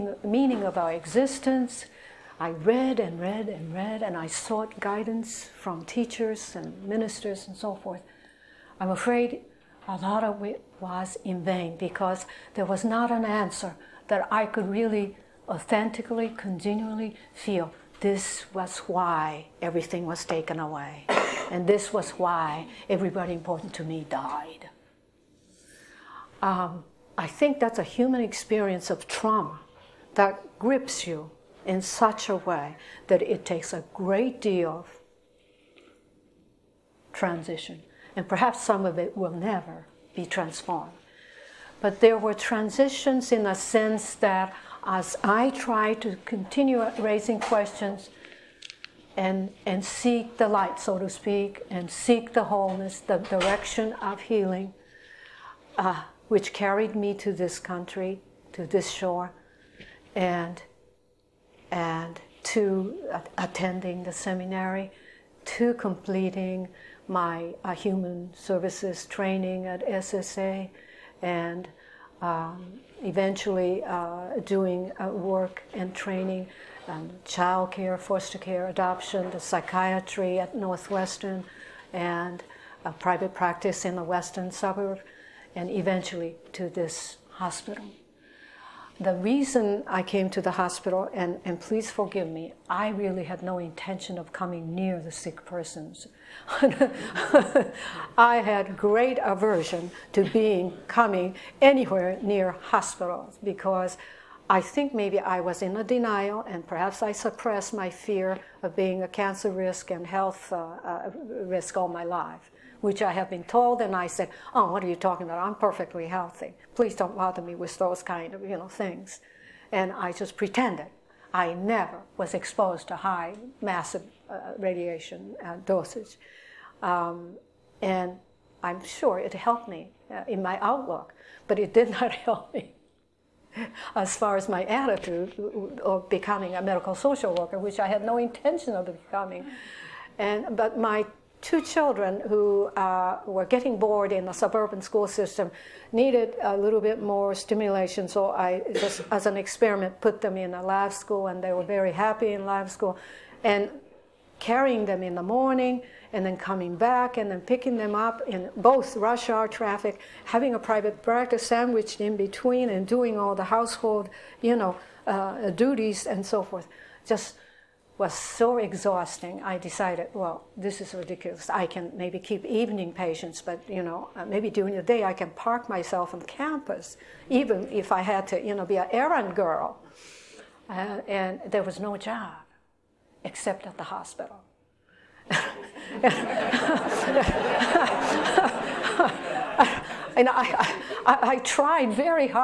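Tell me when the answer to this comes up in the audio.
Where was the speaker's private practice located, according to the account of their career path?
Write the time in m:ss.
1:24.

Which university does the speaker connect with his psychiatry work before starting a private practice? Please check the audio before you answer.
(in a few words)
Northwestern.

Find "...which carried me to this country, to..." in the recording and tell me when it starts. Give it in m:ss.
0:56.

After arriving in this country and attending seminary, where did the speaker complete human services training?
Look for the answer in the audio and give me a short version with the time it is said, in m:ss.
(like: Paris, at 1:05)
SSA, at 1:09.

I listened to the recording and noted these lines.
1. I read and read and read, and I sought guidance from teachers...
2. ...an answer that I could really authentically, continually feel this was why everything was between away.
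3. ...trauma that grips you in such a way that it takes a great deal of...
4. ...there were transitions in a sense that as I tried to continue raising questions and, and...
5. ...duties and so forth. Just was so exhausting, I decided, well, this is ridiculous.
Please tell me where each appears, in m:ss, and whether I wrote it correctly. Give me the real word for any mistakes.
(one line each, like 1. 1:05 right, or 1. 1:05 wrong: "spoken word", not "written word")
1. 0:02 right
2. 0:13 wrong: "taken", not "between"
3. 0:29 right
4. 0:42 right
5. 2:45 right.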